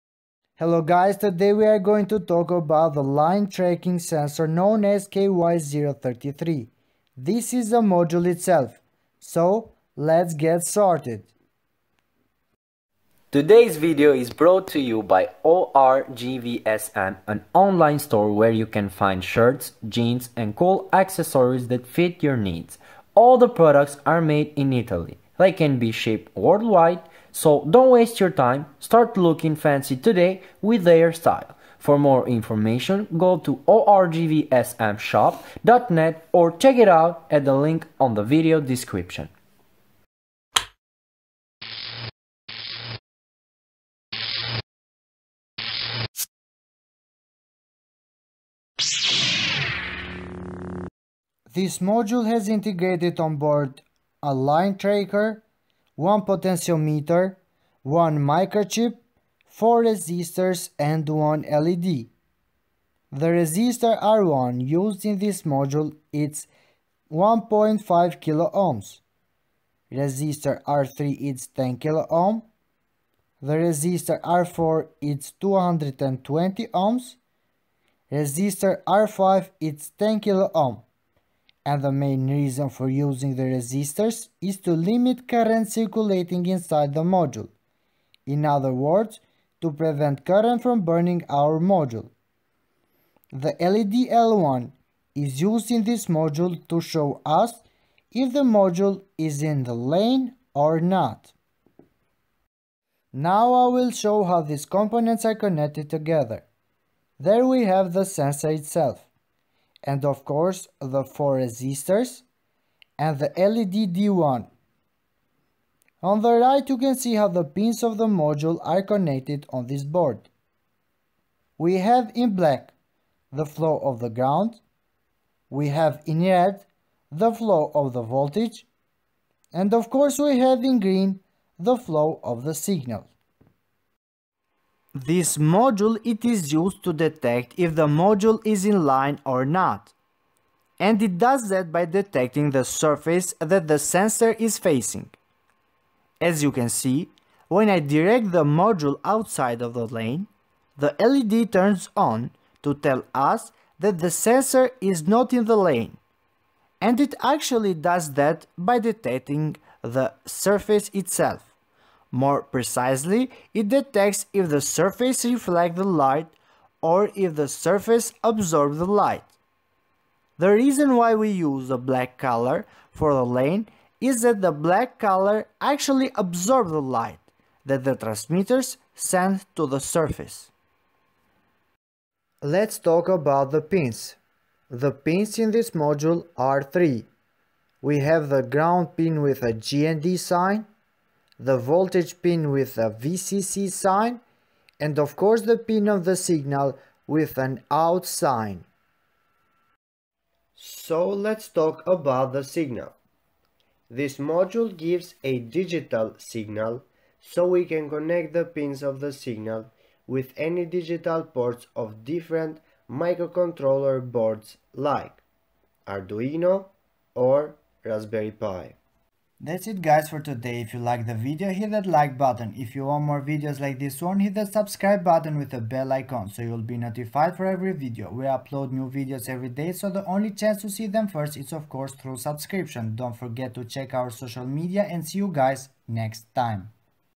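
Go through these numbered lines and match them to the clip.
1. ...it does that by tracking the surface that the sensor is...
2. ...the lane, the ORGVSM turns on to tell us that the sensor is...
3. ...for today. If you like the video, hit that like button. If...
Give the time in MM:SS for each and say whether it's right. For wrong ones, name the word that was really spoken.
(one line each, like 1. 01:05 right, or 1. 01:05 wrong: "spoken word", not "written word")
1. 02:21 wrong: "detecting", not "tracking"
2. 02:29 wrong: "LED", not "ORGVSM"
3. 03:40 right.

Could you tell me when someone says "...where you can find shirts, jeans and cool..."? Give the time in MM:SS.
00:18.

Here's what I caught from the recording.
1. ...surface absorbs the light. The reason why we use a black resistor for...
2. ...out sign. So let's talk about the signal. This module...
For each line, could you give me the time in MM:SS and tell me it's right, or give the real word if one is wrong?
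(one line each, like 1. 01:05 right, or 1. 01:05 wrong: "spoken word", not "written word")
1. 02:47 wrong: "color", not "resistor"
2. 03:17 right.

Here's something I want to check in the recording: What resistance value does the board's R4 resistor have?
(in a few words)
220 ohms.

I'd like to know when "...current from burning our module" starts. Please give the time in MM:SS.
01:30.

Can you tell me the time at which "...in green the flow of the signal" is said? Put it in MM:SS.
02:10.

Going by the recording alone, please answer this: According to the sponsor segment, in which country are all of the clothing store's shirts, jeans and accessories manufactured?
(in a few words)
Italy.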